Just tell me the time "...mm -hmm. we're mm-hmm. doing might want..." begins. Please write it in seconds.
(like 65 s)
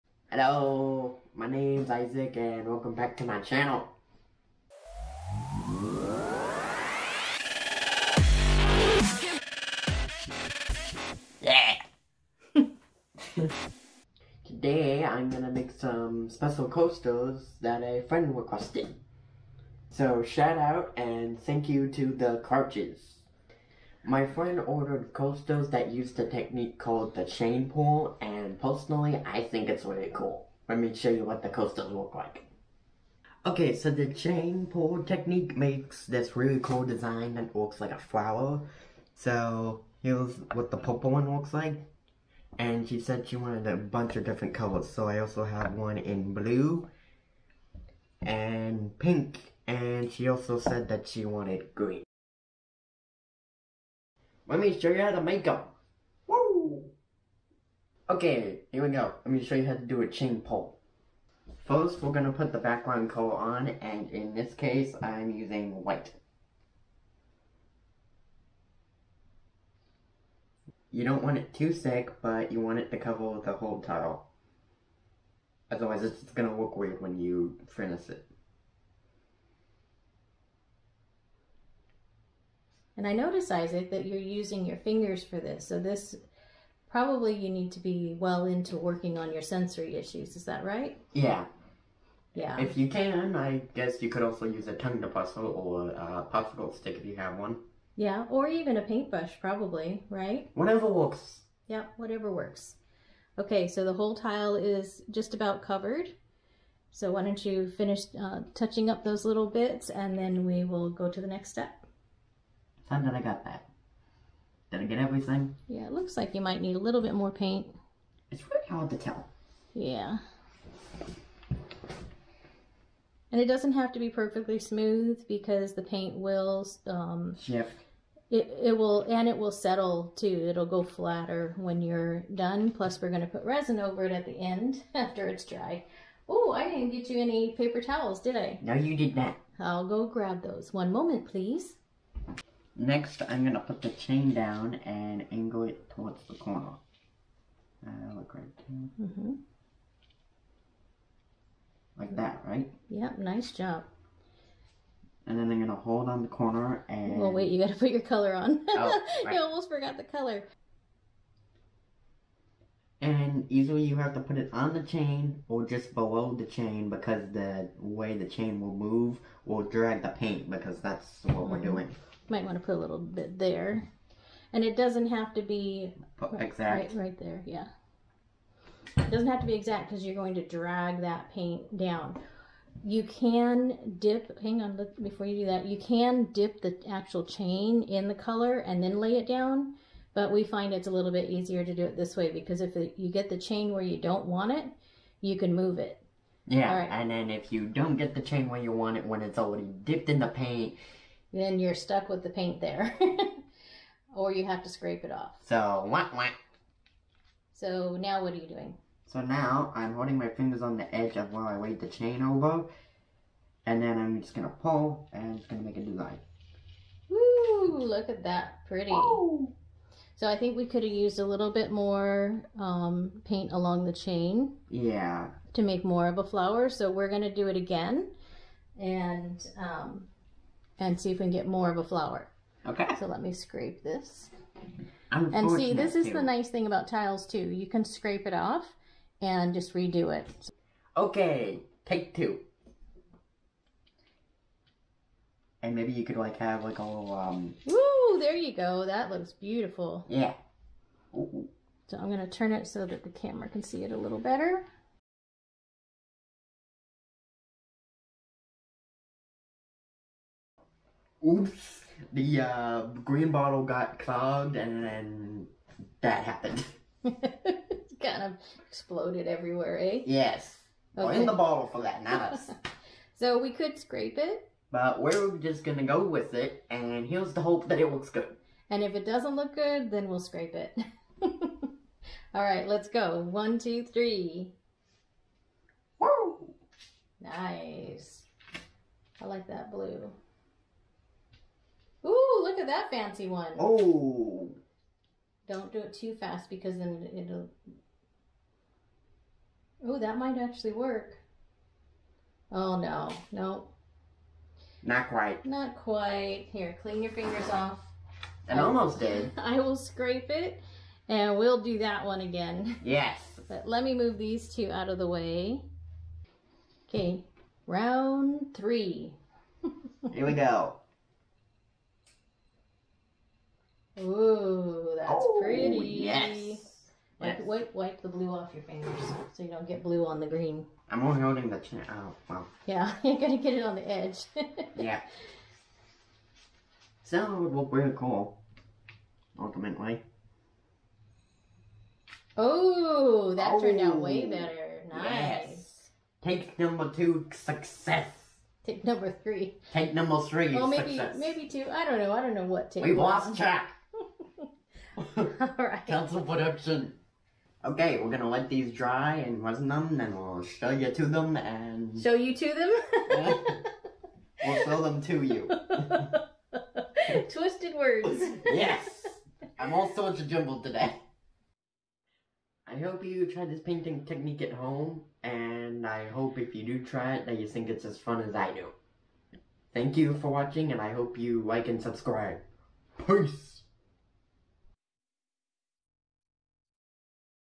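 171 s.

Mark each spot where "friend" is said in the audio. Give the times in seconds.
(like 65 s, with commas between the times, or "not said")
18 s, 24 s.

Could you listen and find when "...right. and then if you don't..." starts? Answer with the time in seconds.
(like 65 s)
196 s.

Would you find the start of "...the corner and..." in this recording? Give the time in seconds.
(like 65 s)
156 s.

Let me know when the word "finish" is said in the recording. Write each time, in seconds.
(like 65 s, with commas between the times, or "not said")
77 s, 107 s.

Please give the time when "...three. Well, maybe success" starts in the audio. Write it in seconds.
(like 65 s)
350 s.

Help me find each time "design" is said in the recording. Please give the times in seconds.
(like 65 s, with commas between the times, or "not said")
36 s, 215 s.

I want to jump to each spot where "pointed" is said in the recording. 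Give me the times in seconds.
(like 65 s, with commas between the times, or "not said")
not said.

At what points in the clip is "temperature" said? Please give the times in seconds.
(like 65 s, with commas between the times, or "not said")
not said.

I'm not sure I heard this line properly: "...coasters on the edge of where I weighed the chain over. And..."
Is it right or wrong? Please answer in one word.
wrong.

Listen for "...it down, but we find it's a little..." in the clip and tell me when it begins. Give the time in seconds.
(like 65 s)
189 s.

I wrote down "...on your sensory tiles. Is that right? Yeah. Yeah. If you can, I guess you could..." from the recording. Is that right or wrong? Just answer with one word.
wrong.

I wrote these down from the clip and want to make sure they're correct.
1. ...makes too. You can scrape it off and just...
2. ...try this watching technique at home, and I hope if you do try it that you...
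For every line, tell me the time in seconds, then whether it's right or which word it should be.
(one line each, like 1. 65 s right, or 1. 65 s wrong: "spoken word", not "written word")
1. 236 s wrong: "tiles", not "makes"
2. 373 s wrong: "painting", not "watching".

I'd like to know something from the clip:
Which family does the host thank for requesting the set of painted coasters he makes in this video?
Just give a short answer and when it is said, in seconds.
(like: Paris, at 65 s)
The Crouches, at 22 s.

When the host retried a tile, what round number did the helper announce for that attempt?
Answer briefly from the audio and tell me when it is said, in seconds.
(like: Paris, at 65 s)
3, at 317 s.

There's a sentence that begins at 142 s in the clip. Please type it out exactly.
Next, I'm going to put the chain down and angle it towards the corner.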